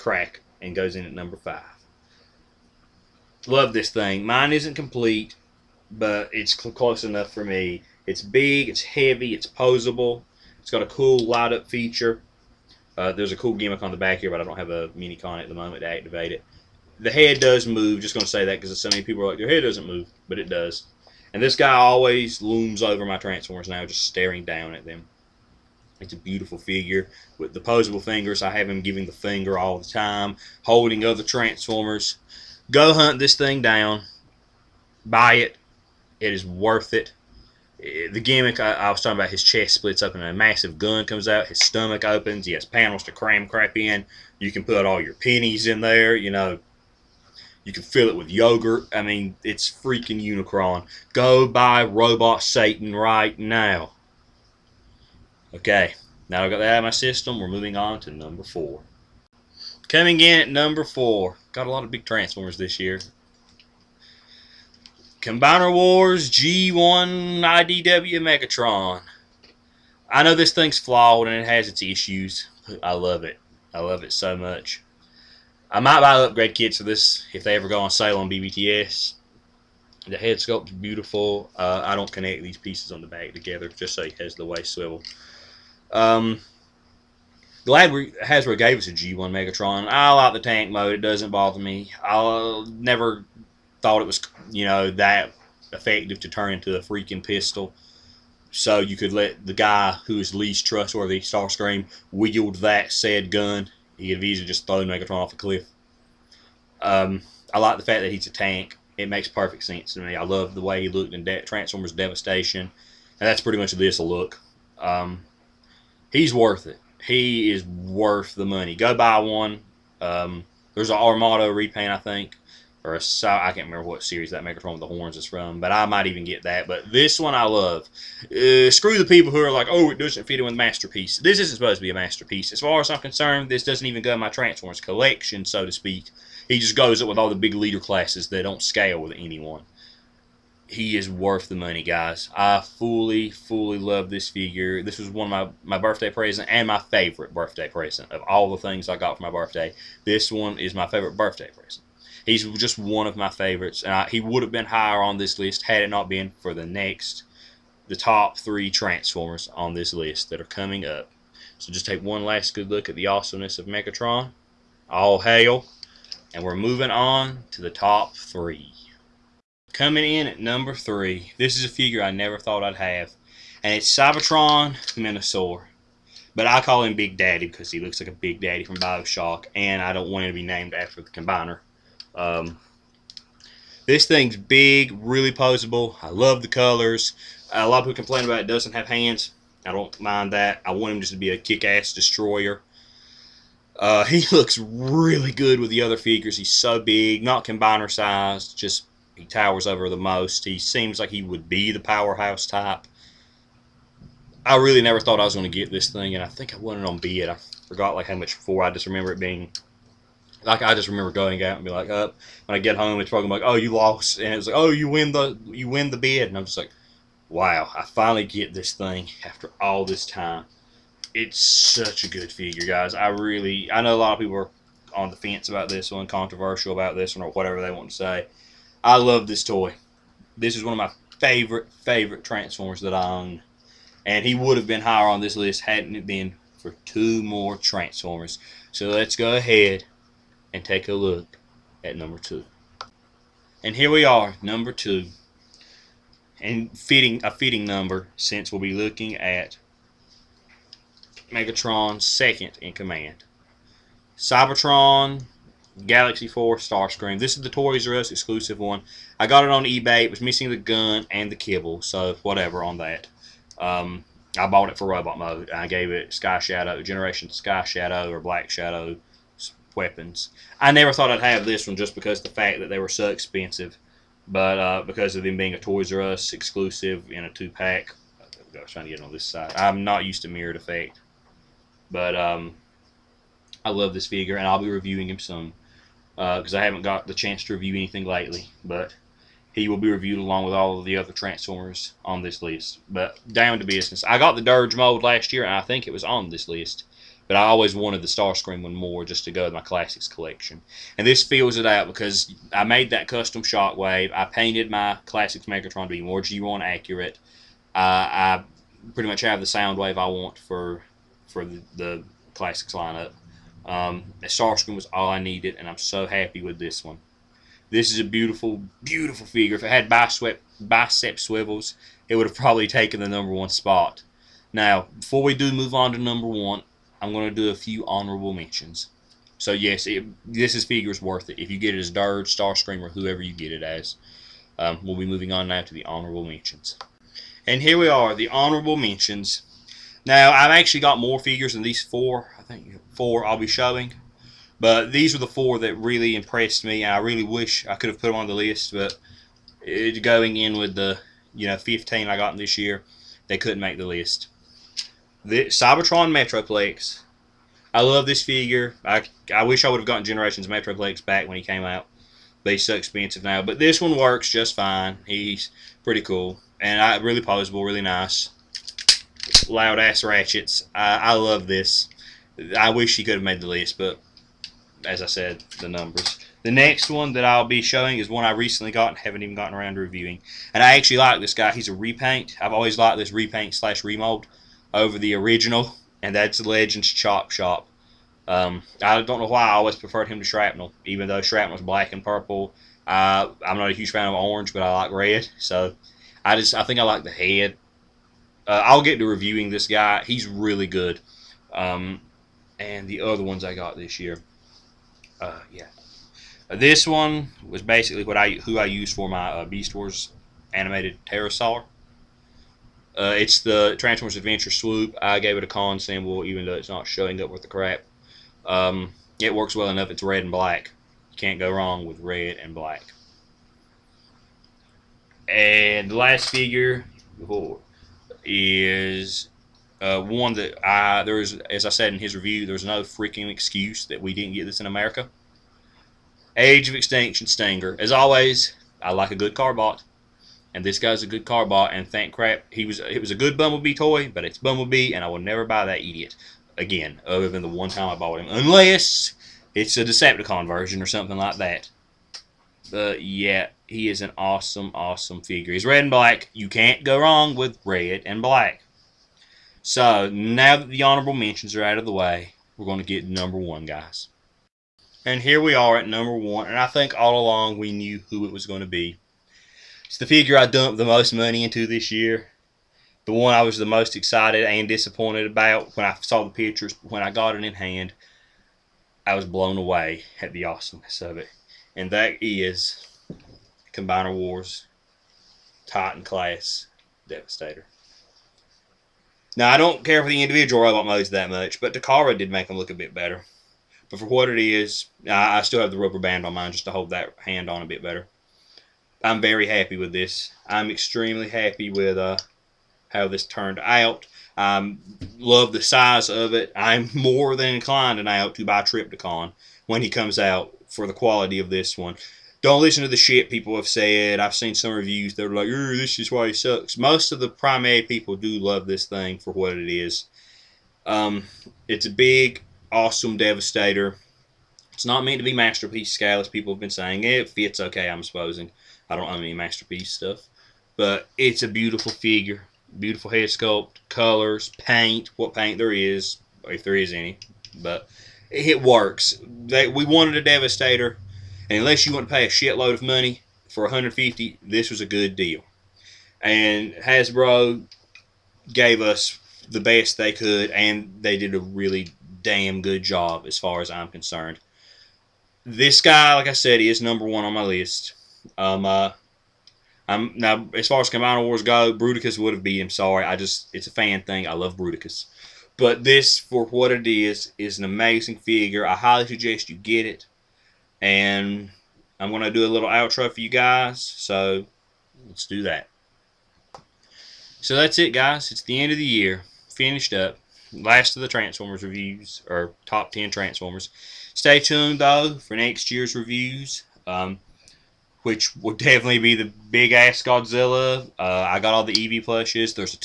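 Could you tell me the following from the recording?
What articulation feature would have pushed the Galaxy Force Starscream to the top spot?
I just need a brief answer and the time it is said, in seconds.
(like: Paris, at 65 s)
Bicep swivels, at 320 s.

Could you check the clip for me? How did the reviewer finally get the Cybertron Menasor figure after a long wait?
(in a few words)
Won it on bid.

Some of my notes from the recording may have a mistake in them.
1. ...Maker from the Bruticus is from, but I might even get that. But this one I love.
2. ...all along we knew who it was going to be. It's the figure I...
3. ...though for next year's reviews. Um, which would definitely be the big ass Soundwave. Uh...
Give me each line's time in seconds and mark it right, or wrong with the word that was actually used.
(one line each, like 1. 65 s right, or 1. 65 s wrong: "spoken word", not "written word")
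1. 124 s wrong: "Horns", not "Bruticus"
2. 466 s right
3. 584 s wrong: "Godzilla", not "Soundwave".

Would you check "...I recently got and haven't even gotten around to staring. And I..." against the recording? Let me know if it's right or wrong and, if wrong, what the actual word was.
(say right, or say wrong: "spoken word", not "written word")
wrong: "reviewing", not "staring".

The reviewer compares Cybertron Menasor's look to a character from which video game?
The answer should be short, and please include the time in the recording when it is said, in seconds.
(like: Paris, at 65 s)
Bioshock, at 178 s.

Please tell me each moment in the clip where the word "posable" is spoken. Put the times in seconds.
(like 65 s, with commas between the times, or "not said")
9 s, 27 s, 185 s.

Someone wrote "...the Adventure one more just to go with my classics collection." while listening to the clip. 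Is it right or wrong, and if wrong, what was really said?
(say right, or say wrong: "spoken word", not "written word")
wrong: "Starscream", not "Adventure".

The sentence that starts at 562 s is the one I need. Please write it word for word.
Sorry, I just it's a fan thing.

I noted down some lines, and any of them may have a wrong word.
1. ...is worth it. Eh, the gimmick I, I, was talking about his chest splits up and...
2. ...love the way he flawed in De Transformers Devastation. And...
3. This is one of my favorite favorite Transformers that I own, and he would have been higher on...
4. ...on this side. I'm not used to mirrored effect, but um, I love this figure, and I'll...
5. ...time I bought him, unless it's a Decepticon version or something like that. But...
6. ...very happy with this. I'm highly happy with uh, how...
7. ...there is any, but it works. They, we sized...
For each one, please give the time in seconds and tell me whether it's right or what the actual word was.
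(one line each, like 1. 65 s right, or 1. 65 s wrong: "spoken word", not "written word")
1. 36 s right
2. 110 s wrong: "looked", not "flawed"
3. 230 s right
4. 279 s right
5. 447 s right
6. 499 s wrong: "extremely", not "highly"
7. 536 s wrong: "wanted", not "sized".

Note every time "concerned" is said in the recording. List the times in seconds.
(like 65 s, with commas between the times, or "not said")
132 s, 553 s.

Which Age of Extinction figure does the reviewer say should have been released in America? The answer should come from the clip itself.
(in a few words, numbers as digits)
Stinger.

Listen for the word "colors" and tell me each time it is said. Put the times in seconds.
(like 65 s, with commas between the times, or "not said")
186 s, 533 s.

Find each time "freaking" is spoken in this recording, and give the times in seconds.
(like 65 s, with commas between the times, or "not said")
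49 s, 96 s, 432 s.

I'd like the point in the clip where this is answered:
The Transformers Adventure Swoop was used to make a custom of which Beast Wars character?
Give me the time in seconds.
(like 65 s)
411 s.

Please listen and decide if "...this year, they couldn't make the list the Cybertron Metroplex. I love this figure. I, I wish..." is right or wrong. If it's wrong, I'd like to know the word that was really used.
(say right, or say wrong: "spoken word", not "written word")
right.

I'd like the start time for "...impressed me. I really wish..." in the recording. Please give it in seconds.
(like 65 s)
346 s.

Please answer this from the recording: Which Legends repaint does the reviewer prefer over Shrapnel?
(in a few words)
Chop Shop.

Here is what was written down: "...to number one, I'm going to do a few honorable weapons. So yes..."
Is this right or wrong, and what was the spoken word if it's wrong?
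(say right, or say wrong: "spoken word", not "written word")
wrong: "mentions", not "weapons".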